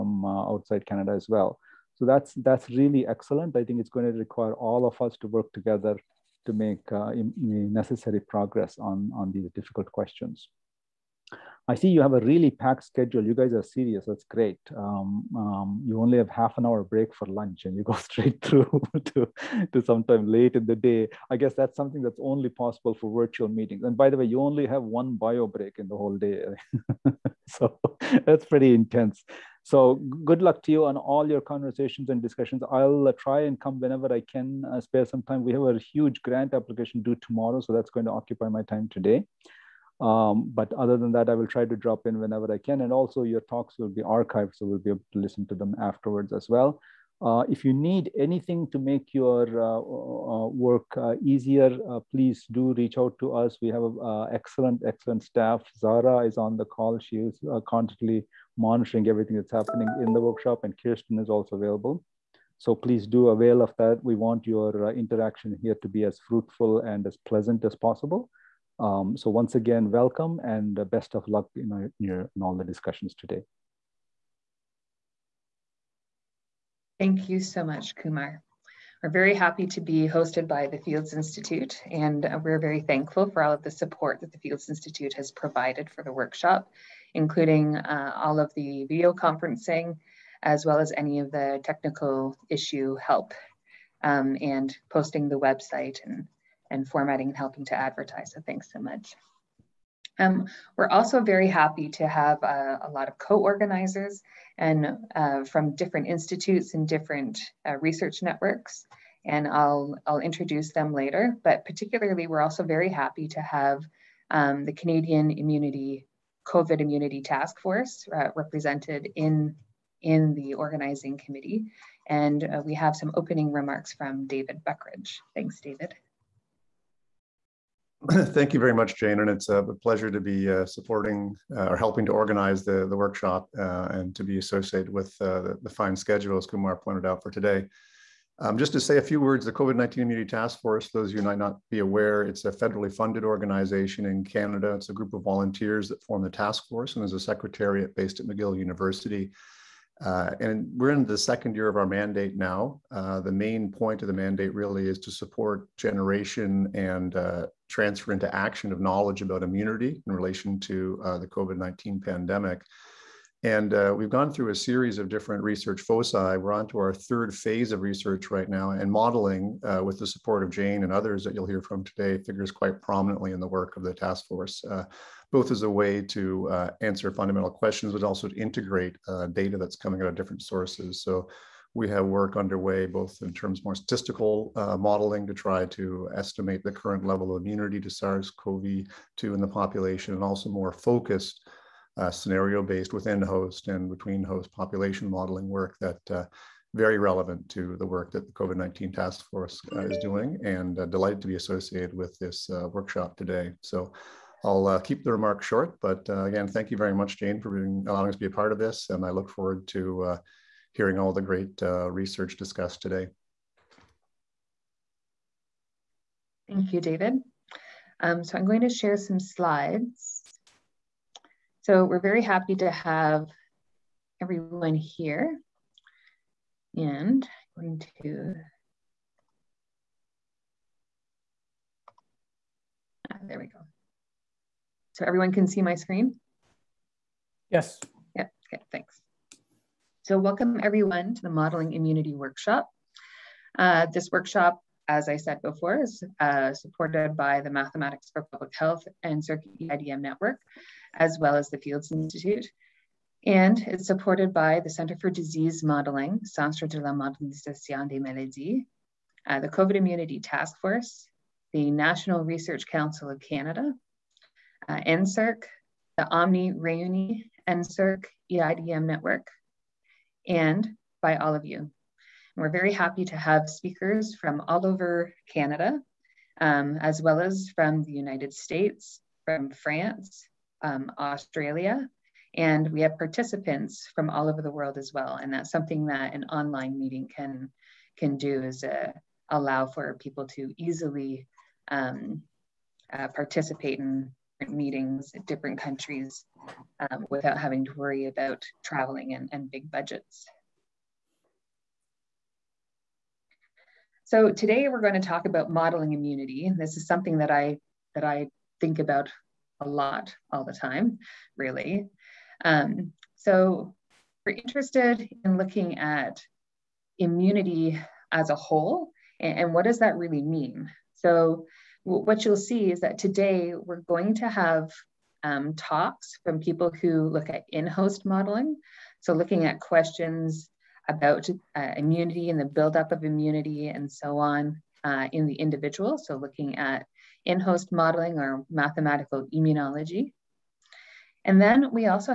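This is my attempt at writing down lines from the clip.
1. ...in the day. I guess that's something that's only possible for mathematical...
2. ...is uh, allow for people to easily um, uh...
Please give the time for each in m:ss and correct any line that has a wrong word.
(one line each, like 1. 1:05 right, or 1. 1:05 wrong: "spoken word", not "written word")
1. 0:20 wrong: "virtual", not "mathematical"
2. 4:48 right.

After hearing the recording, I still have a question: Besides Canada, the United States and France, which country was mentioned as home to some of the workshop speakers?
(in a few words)
Australia.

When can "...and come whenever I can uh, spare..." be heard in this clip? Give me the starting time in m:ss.
0:33.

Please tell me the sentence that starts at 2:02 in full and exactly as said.
And uh, we have some opening remarks from David Buckeridge.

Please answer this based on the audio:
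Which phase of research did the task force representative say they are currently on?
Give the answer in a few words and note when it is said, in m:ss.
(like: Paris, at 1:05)
third, at 2:46.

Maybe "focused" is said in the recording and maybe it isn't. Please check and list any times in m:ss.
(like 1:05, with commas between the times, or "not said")
3:10.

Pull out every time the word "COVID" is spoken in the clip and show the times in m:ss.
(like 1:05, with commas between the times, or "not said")
1:56, 2:19, 2:41, 3:18, 4:19.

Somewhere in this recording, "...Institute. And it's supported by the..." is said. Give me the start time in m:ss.
4:11.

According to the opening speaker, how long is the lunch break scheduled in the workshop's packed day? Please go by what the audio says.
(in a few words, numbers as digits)
half an hour.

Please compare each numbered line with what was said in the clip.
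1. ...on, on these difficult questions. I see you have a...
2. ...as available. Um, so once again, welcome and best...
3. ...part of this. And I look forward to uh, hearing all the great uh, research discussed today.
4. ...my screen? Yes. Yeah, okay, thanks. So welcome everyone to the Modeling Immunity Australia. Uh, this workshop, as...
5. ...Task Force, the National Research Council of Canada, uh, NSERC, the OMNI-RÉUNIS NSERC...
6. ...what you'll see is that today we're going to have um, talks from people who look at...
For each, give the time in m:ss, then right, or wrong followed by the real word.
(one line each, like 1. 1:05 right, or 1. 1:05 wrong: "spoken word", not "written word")
1. 0:08 right
2. 1:07 wrong: "possible", not "available"
3. 3:28 right
4. 3:55 wrong: "Workshop", not "Australia"
5. 4:20 right
6. 5:21 right.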